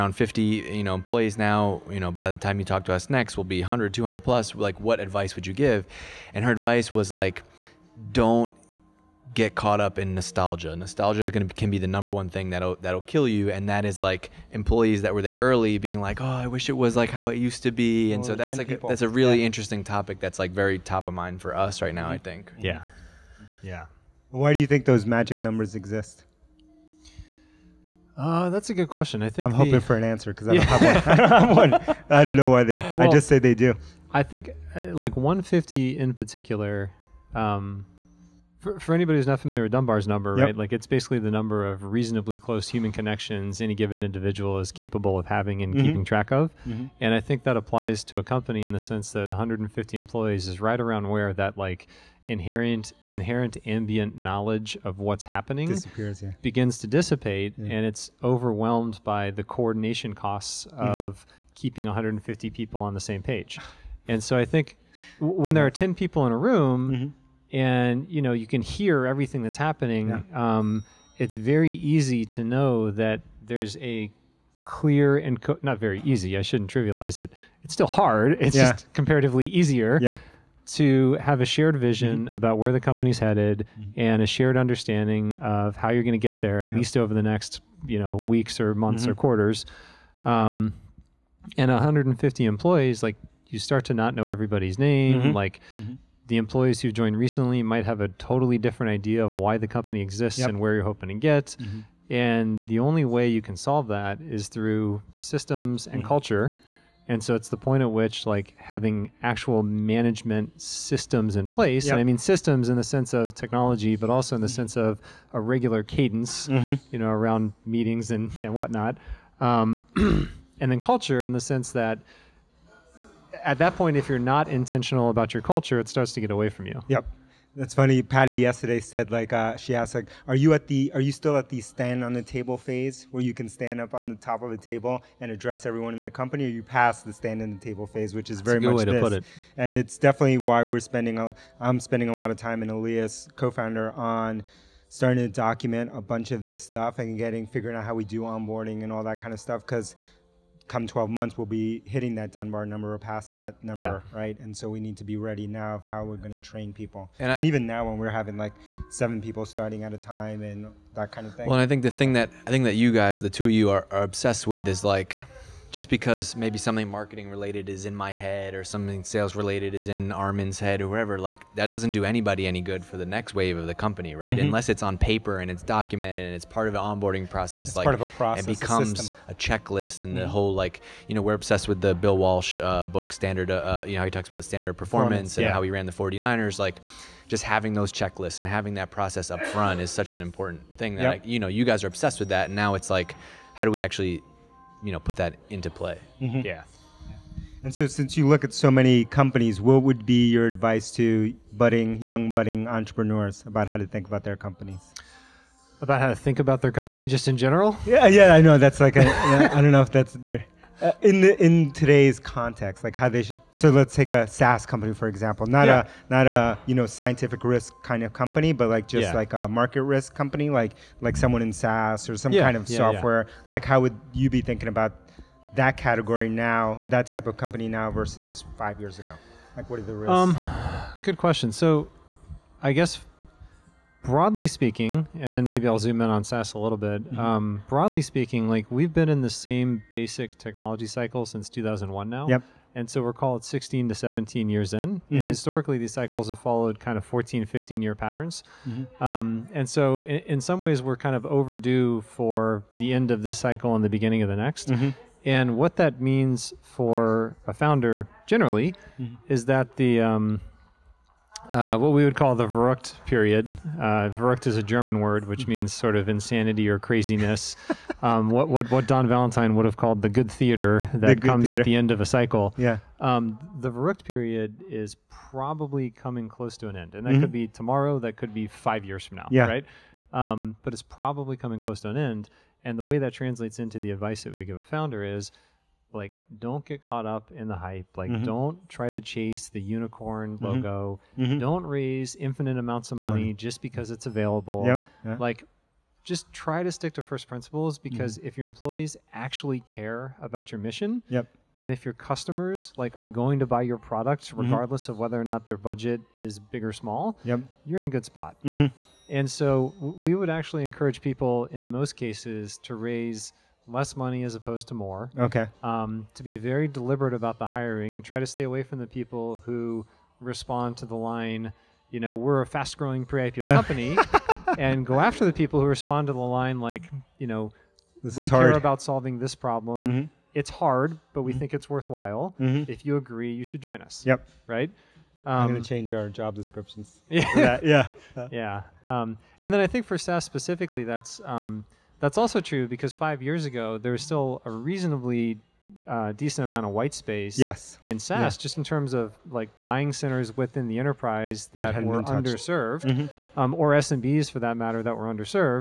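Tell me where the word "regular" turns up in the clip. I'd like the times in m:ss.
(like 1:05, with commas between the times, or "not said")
1:55.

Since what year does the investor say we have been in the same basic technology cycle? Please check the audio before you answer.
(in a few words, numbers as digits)
2001.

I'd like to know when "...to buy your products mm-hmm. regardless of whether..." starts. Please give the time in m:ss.
5:03.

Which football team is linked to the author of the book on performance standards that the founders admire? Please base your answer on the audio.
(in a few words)
49ers.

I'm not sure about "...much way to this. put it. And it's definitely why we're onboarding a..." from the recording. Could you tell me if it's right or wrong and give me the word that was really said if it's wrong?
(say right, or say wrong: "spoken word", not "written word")
wrong: "spending", not "onboarding".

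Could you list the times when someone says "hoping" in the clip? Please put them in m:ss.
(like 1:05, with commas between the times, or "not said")
0:29, 1:40.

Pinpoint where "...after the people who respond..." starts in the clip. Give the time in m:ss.
5:24.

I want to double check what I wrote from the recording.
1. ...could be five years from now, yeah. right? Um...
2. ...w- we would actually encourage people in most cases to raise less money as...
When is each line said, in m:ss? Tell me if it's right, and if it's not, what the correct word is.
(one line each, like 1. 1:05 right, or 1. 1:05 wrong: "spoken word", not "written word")
1. 4:38 right
2. 5:09 right.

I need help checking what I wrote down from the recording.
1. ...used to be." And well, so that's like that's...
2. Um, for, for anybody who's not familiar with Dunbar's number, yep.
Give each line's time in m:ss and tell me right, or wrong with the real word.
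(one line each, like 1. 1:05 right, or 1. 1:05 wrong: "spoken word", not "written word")
1. 0:17 right
2. 0:37 right.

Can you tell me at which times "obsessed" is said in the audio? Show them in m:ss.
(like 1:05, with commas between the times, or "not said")
2:44, 3:01, 3:11.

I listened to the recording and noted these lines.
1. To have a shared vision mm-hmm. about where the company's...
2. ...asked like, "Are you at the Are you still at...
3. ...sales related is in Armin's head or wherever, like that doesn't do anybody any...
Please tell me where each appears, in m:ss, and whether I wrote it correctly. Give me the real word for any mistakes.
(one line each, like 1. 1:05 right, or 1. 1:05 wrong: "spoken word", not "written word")
1. 1:20 right
2. 2:09 right
3. 2:49 right.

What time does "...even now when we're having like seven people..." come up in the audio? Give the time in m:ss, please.
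2:37.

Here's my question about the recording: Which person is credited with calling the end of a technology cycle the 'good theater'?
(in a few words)
Don Valentine.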